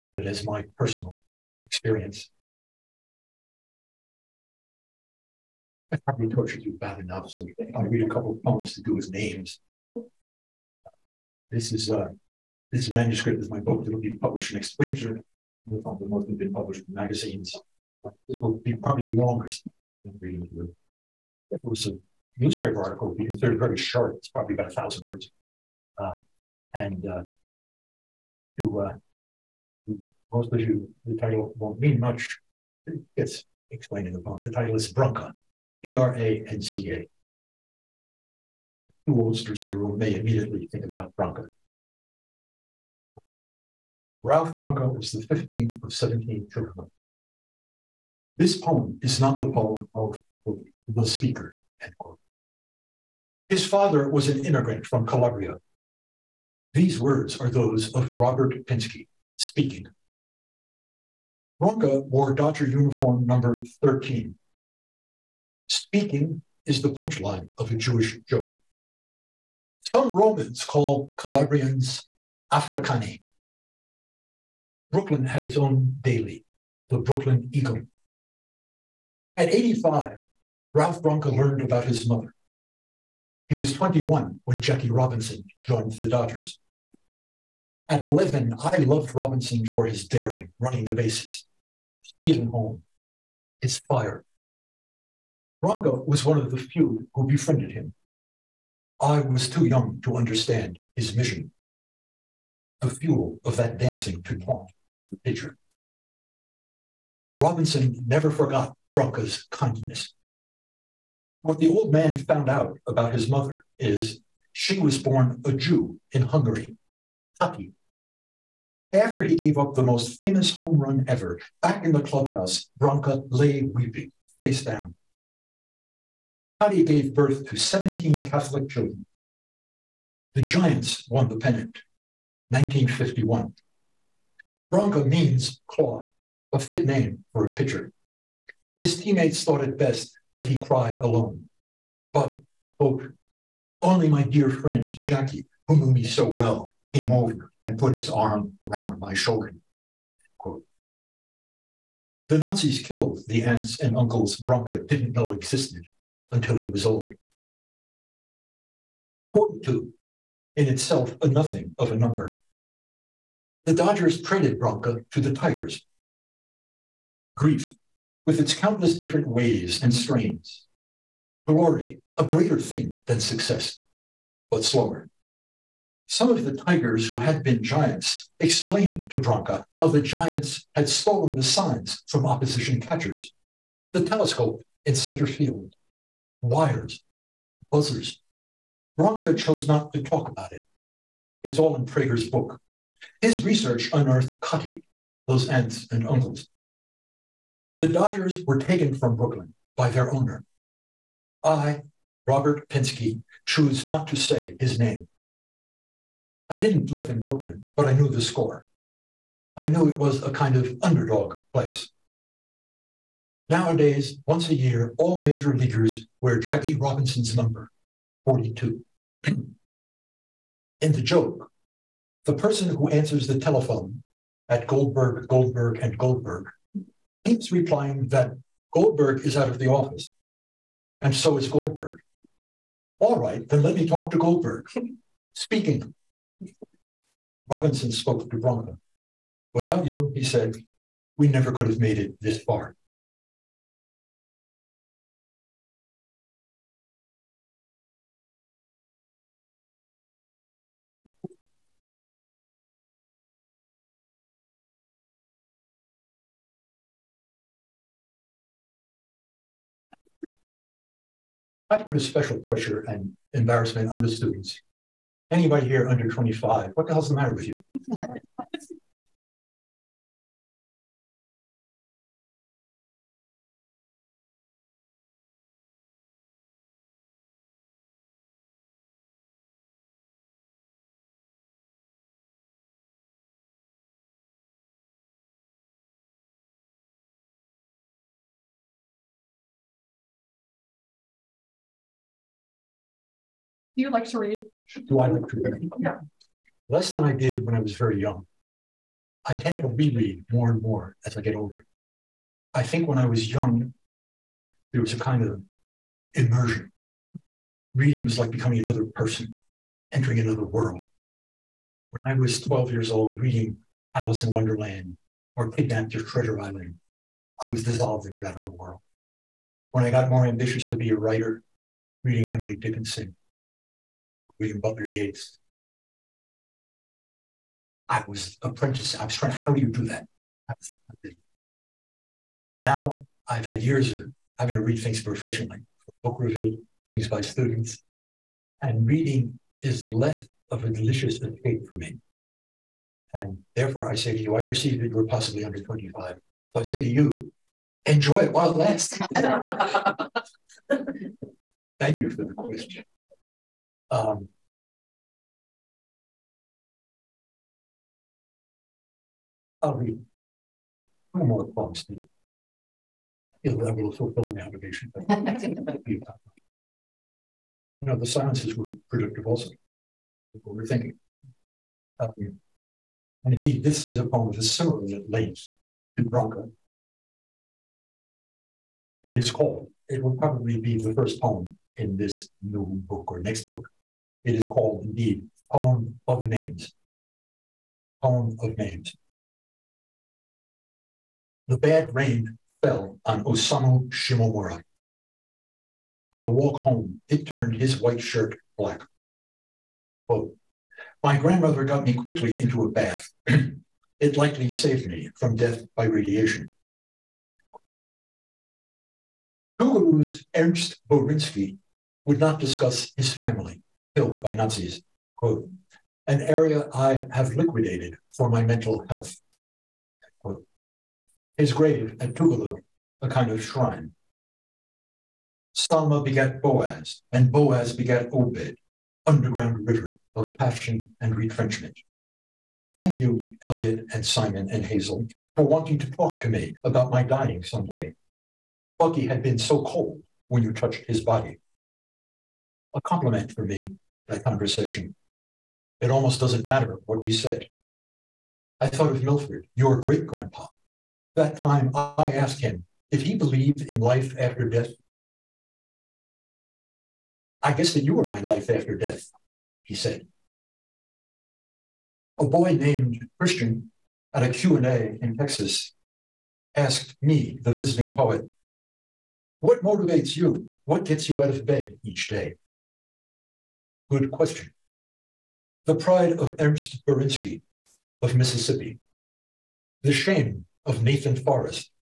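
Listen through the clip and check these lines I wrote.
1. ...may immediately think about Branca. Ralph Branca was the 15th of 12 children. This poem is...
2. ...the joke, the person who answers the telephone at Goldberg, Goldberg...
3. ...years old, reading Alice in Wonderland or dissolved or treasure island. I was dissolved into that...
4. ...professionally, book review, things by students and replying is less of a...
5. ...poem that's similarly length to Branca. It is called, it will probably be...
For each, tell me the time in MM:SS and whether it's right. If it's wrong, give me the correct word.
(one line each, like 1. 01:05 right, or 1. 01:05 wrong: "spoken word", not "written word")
1. 00:39 wrong: "17", not "12"
2. 03:40 right
3. 05:12 wrong: "kidnapped", not "dissolved"
4. 05:35 wrong: "reading", not "replying"
5. 06:14 right.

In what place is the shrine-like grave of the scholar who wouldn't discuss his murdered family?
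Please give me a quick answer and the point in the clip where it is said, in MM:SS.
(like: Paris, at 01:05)
Tougaloo, at 07:02.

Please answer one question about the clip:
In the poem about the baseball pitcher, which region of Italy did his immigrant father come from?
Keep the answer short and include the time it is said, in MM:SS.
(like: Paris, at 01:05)
Calabria, at 00:55.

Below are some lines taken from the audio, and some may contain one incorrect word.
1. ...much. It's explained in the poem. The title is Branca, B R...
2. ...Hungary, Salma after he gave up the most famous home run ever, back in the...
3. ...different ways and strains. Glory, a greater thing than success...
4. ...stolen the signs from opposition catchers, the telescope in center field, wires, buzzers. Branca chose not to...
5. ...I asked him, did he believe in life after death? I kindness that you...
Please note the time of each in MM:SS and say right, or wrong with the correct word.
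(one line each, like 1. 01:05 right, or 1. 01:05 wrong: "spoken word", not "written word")
1. 00:32 right
2. 01:56 wrong: "Kati", not "Salma"
3. 02:48 right
4. 03:00 right
5. 07:31 wrong: "guess", not "kindness".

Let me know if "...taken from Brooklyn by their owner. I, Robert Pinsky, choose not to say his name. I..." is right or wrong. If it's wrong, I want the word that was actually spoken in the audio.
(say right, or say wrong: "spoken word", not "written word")
right.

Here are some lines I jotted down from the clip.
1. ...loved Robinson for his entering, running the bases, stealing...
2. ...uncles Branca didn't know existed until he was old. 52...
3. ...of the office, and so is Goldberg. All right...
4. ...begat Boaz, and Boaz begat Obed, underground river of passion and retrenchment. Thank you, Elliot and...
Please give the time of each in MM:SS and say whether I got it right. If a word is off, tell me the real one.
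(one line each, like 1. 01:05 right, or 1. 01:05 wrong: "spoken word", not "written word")
1. 01:28 wrong: "daring", not "entering"
2. 02:33 wrong: "42", not "52"
3. 03:49 right
4. 07:06 right.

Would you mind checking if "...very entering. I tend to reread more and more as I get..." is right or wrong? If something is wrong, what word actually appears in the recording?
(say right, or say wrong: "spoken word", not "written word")
wrong: "young", not "entering".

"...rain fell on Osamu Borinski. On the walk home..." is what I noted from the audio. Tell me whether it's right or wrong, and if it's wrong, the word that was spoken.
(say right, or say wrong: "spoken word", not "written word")
wrong: "Shimomura", not "Borinski".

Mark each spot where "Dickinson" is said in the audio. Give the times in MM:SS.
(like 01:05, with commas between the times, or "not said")
05:22.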